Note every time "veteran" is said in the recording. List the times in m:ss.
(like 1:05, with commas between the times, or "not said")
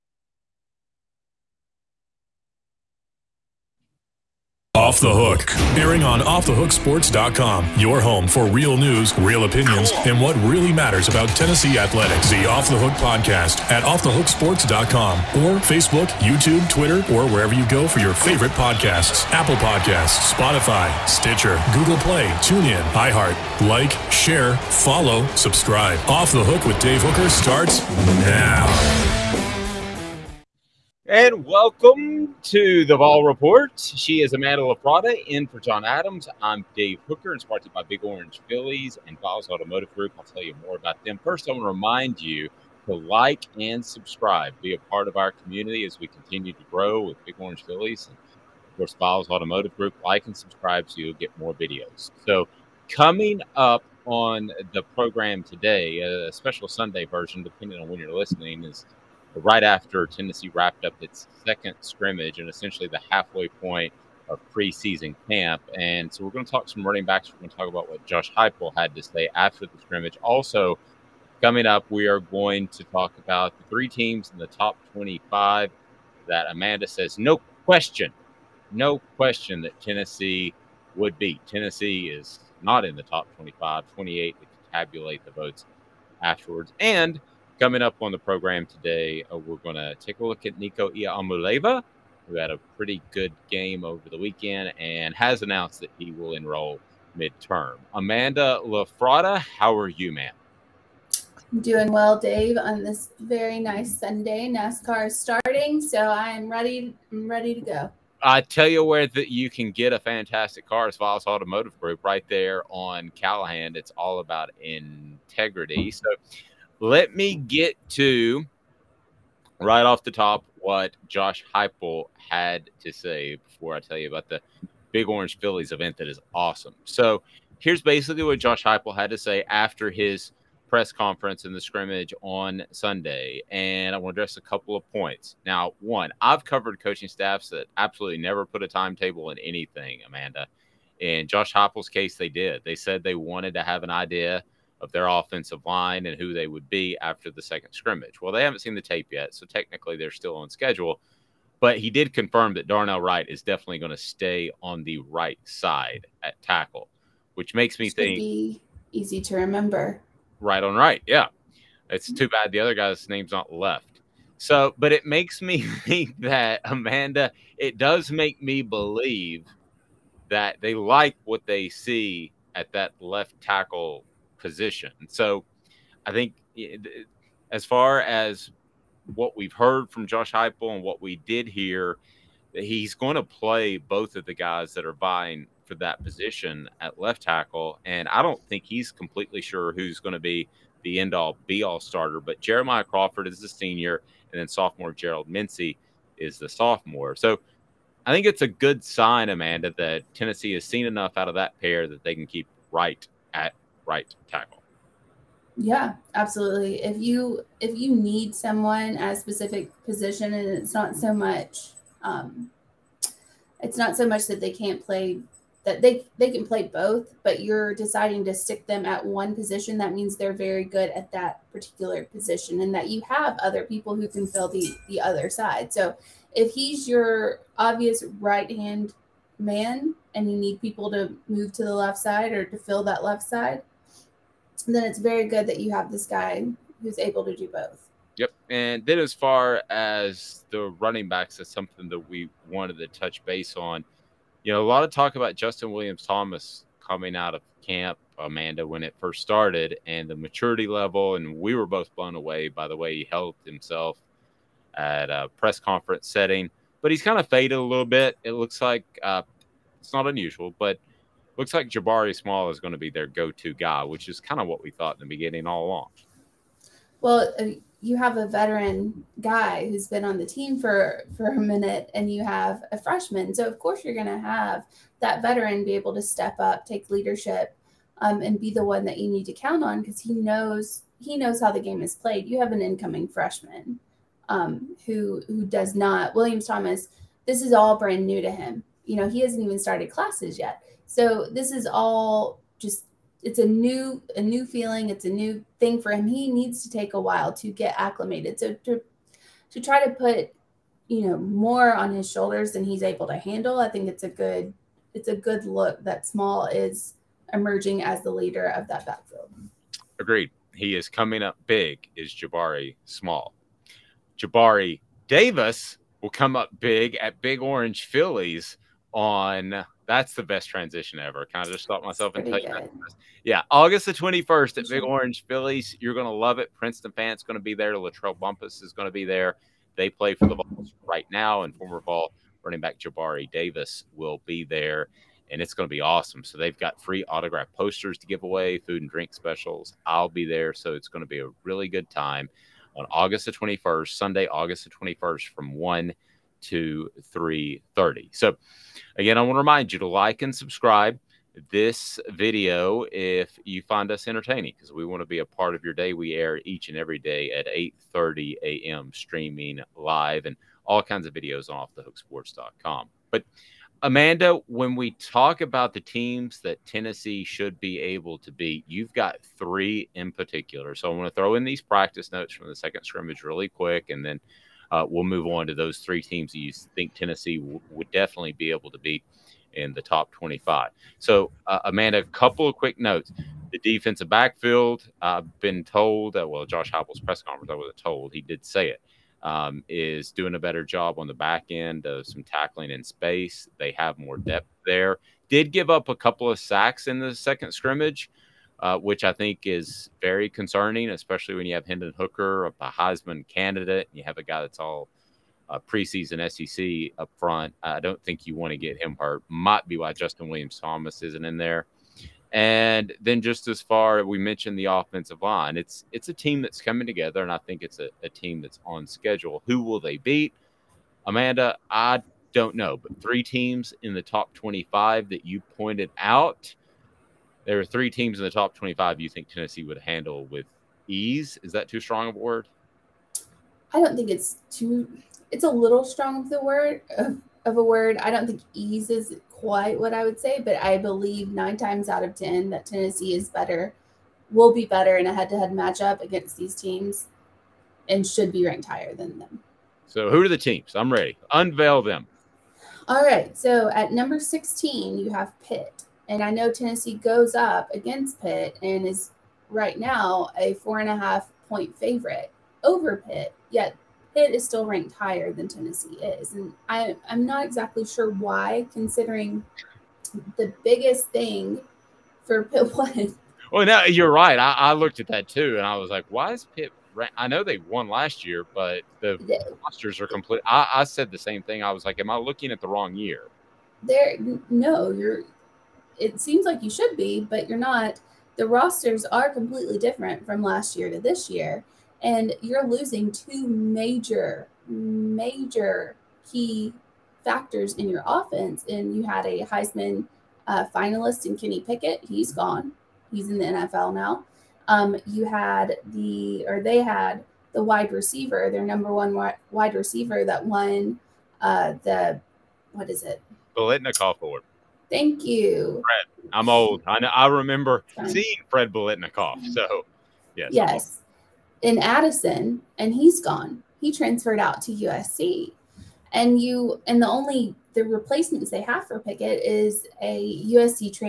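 4:28, 4:35.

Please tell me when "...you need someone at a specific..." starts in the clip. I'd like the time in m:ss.
3:27.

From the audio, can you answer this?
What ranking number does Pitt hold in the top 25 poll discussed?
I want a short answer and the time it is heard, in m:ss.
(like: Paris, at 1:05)
16, at 7:33.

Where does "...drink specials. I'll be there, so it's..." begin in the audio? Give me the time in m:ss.
5:38.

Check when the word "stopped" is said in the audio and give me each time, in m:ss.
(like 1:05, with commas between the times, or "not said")
5:21.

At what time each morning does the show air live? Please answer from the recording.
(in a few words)
8:30 a.m.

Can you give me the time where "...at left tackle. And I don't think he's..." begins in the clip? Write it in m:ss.
3:06.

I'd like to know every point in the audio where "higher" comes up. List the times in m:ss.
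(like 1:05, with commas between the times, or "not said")
7:28, 7:44.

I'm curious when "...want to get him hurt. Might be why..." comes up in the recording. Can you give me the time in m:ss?
6:48.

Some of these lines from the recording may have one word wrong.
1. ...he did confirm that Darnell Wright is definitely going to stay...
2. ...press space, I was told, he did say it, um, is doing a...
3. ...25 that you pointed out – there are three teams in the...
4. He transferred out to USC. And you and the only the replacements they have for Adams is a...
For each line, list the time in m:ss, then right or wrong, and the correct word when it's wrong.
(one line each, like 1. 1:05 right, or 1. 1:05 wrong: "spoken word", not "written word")
1. 2:31 right
2. 6:27 wrong: "conference", not "space"
3. 7:04 right
4. 8:43 wrong: "Pickett", not "Adams".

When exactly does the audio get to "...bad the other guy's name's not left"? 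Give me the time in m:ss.
2:42.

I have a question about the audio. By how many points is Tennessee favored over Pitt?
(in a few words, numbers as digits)
4.5.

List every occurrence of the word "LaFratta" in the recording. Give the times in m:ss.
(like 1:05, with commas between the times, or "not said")
0:34, 1:38.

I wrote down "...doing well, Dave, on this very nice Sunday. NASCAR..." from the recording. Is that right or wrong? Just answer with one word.
right.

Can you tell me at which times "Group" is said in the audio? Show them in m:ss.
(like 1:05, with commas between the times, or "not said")
0:39, 0:49, 1:51.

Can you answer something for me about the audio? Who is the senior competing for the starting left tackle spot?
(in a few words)
Jeremiah Crawford.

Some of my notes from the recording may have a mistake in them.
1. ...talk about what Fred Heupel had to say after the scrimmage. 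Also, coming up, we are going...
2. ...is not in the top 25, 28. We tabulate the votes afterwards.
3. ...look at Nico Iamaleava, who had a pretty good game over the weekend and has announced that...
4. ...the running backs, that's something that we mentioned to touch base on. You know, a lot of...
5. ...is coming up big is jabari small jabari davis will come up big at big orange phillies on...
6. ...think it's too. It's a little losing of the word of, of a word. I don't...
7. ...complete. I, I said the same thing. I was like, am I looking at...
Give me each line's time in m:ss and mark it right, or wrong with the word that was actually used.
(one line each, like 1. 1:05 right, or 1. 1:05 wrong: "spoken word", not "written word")
1. 1:07 wrong: "Josh", not "Fred"
2. 1:22 right
3. 1:30 right
4. 4:00 wrong: "wanted", not "mentioned"
5. 5:10 right
6. 7:13 wrong: "strong", not "losing"
7. 8:00 right.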